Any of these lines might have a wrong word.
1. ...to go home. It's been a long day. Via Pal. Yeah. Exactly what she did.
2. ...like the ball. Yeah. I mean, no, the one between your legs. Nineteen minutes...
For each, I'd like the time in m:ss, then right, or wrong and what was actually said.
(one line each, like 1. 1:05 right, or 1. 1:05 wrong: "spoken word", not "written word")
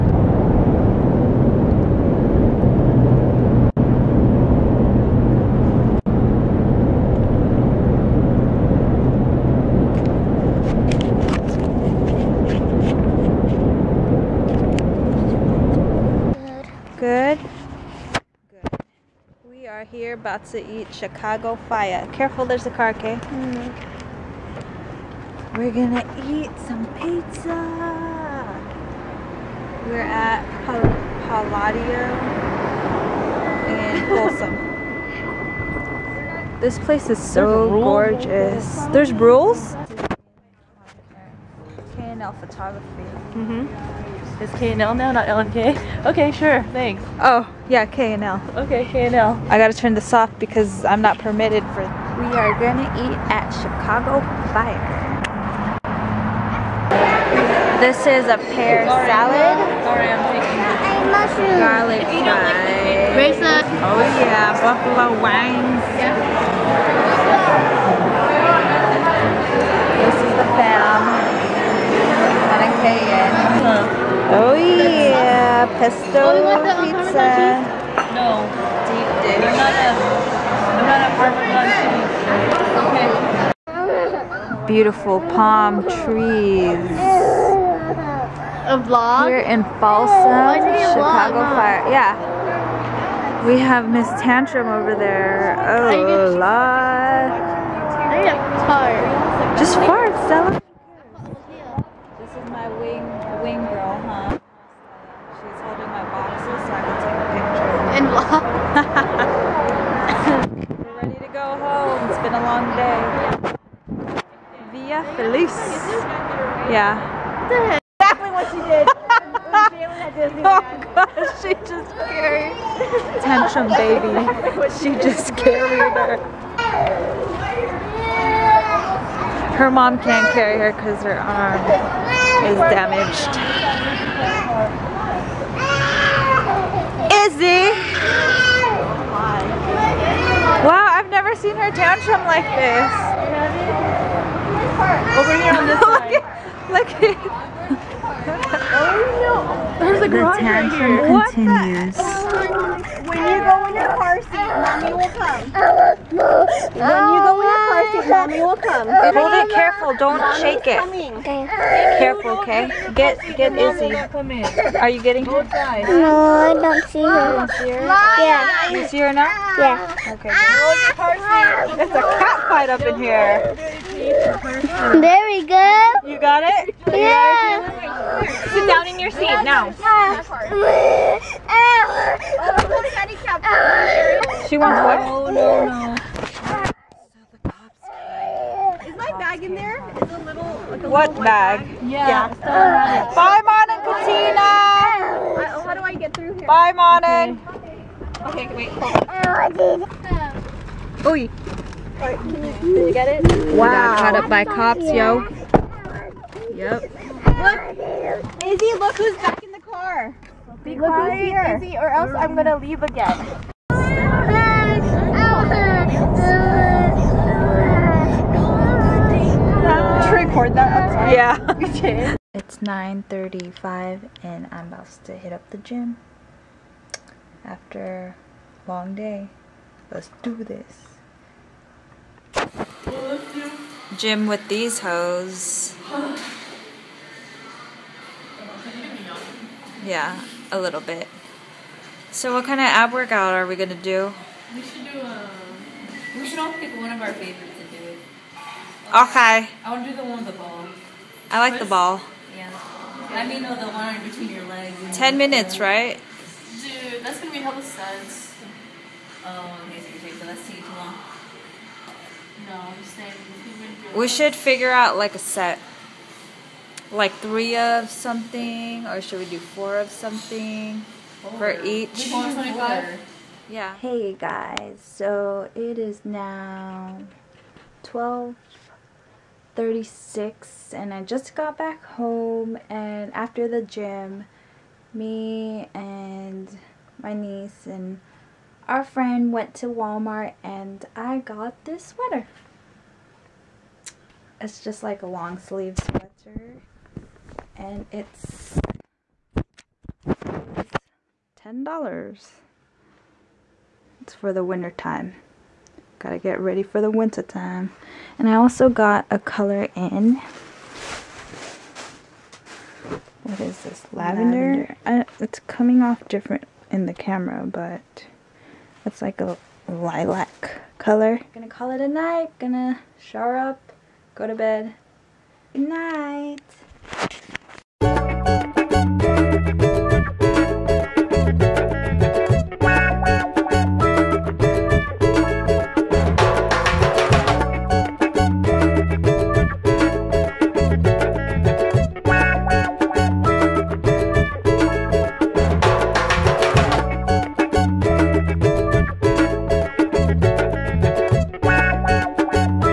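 1. 1:51 wrong: "Feliz", not "Pal"
2. 4:11 wrong: "Ten", not "Nineteen".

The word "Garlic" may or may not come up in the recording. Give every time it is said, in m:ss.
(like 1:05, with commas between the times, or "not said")
1:01.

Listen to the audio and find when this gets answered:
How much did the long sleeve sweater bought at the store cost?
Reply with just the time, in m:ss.
5:01.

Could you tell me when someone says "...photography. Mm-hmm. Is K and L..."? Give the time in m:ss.
0:42.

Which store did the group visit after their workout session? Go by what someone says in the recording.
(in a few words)
Walmart.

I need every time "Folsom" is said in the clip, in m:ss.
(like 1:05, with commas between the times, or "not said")
0:34, 1:29.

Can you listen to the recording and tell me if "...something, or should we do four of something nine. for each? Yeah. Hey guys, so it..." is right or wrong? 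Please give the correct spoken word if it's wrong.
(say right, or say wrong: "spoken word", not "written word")
wrong: "four", not "nine".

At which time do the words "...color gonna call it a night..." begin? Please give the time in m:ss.
5:20.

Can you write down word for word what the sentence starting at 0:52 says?
We are gonna eat at Chicago Fire.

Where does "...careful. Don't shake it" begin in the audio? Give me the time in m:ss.
2:39.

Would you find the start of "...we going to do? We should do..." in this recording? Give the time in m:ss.
4:03.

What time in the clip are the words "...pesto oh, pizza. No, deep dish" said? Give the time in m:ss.
1:15.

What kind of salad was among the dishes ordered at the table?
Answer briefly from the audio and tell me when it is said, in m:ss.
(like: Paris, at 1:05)
Pear salad, at 0:58.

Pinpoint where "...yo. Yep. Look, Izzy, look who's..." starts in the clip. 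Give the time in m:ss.
3:24.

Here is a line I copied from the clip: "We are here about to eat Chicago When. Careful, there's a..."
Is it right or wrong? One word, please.
wrong.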